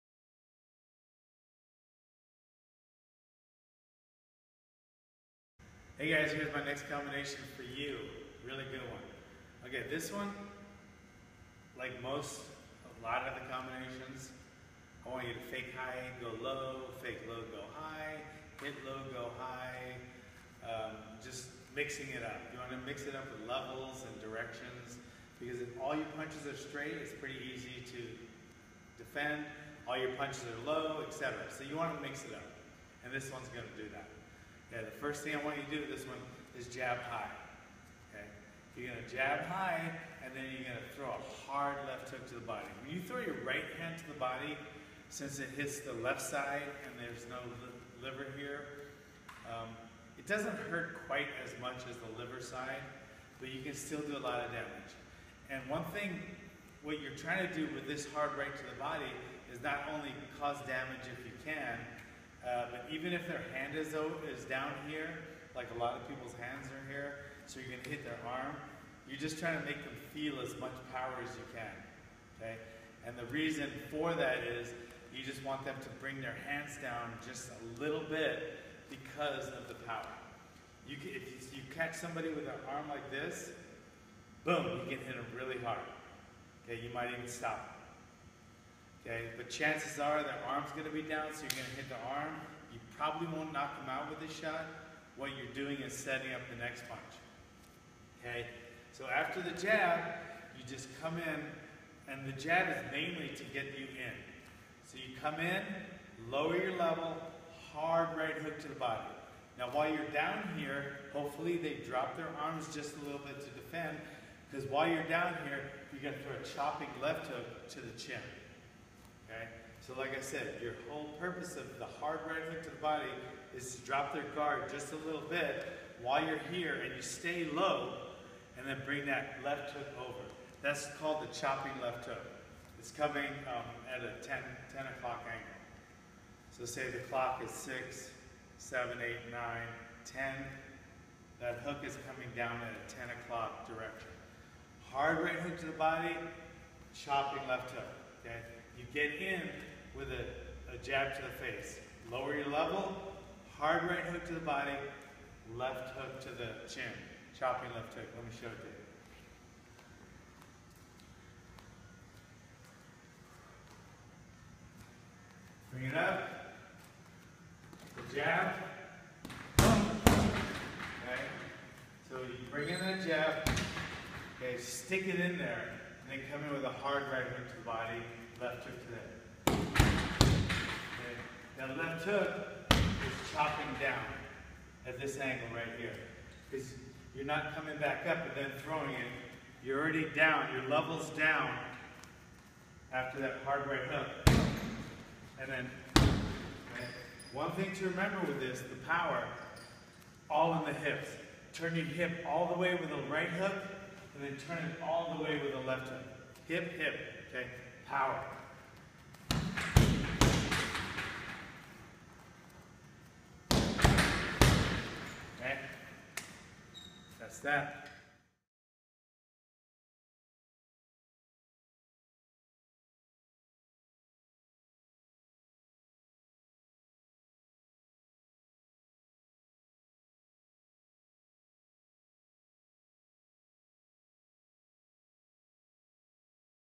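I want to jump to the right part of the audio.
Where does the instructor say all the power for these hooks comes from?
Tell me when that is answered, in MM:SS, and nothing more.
03:20.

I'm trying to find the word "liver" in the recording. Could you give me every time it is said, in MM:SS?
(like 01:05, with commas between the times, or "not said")
00:48, 00:52.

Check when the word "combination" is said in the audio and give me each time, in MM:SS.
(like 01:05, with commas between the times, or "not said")
00:06, 00:13.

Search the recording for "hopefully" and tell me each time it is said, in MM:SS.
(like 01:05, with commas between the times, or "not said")
01:51.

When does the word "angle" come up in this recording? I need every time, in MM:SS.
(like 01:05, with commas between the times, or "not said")
02:15, 03:05.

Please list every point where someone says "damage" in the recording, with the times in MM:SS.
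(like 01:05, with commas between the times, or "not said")
00:54, 01:00.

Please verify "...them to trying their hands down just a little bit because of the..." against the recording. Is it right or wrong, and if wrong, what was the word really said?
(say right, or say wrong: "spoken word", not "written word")
wrong: "bring", not "trying".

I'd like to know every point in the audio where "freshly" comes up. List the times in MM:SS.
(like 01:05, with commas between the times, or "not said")
not said.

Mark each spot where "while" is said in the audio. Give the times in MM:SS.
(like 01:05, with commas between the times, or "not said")
01:49, 01:54, 02:06.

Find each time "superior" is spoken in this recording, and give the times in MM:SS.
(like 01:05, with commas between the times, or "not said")
not said.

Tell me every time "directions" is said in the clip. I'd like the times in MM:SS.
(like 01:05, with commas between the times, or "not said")
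00:24, 02:23.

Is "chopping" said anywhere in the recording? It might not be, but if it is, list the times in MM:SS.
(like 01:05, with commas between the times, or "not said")
01:56, 02:11, 02:26, 02:37, 03:03.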